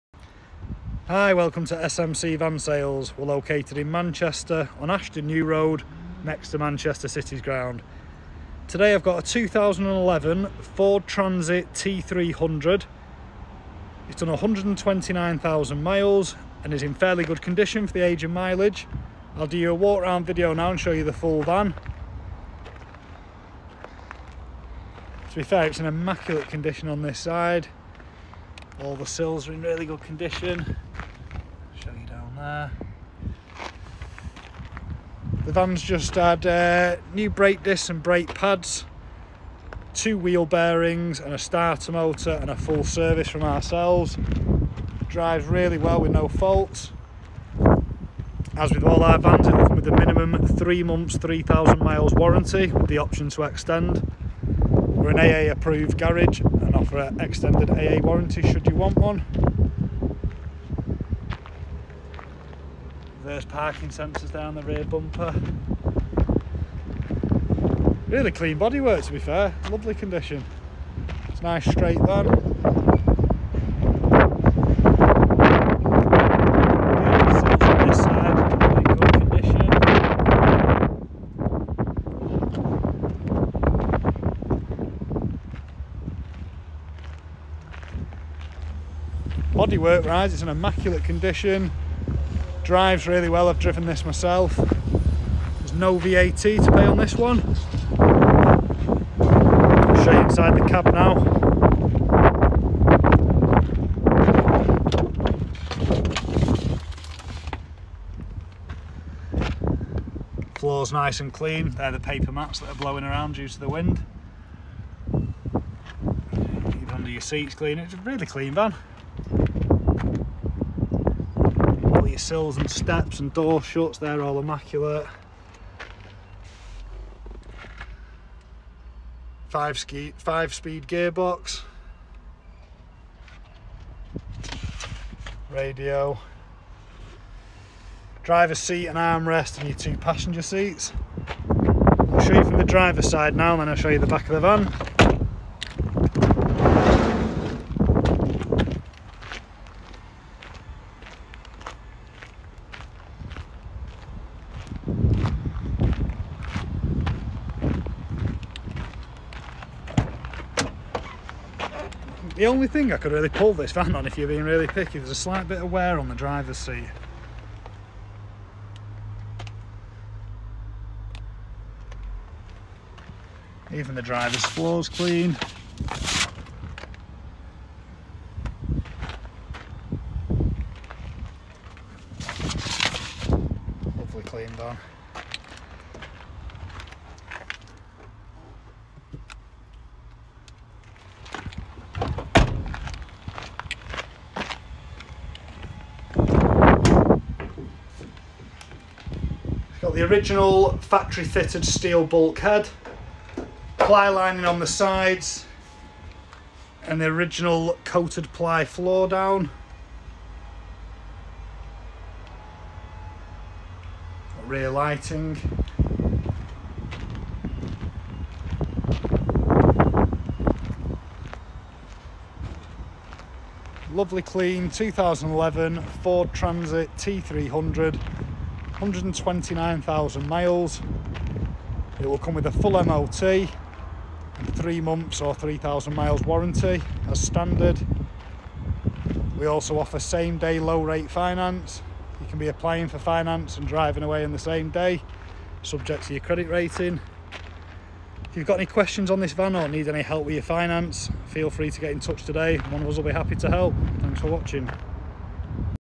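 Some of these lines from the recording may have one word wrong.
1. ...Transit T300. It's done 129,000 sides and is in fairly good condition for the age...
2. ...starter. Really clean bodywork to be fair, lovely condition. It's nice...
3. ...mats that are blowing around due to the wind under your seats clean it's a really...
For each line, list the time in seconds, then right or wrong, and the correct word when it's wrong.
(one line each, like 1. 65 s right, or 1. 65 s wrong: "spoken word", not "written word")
1. 11 s wrong: "miles", not "sides"
2. 64 s wrong: "bumper", not "starter"
3. 112 s right.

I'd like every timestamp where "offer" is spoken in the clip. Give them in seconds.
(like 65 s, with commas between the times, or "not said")
56 s, 239 s.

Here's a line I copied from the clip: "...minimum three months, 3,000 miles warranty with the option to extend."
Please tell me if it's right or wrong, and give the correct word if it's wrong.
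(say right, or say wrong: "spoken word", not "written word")
right.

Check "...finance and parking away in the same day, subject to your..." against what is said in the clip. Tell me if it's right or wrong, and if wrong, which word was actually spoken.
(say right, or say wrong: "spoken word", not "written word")
wrong: "driving", not "parking".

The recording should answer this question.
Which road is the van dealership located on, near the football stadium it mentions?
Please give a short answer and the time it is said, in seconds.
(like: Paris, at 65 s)
Ashton New Road, at 4 s.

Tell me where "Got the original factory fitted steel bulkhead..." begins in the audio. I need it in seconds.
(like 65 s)
199 s.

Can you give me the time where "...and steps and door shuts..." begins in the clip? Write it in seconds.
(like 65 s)
122 s.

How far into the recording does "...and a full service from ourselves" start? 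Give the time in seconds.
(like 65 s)
42 s.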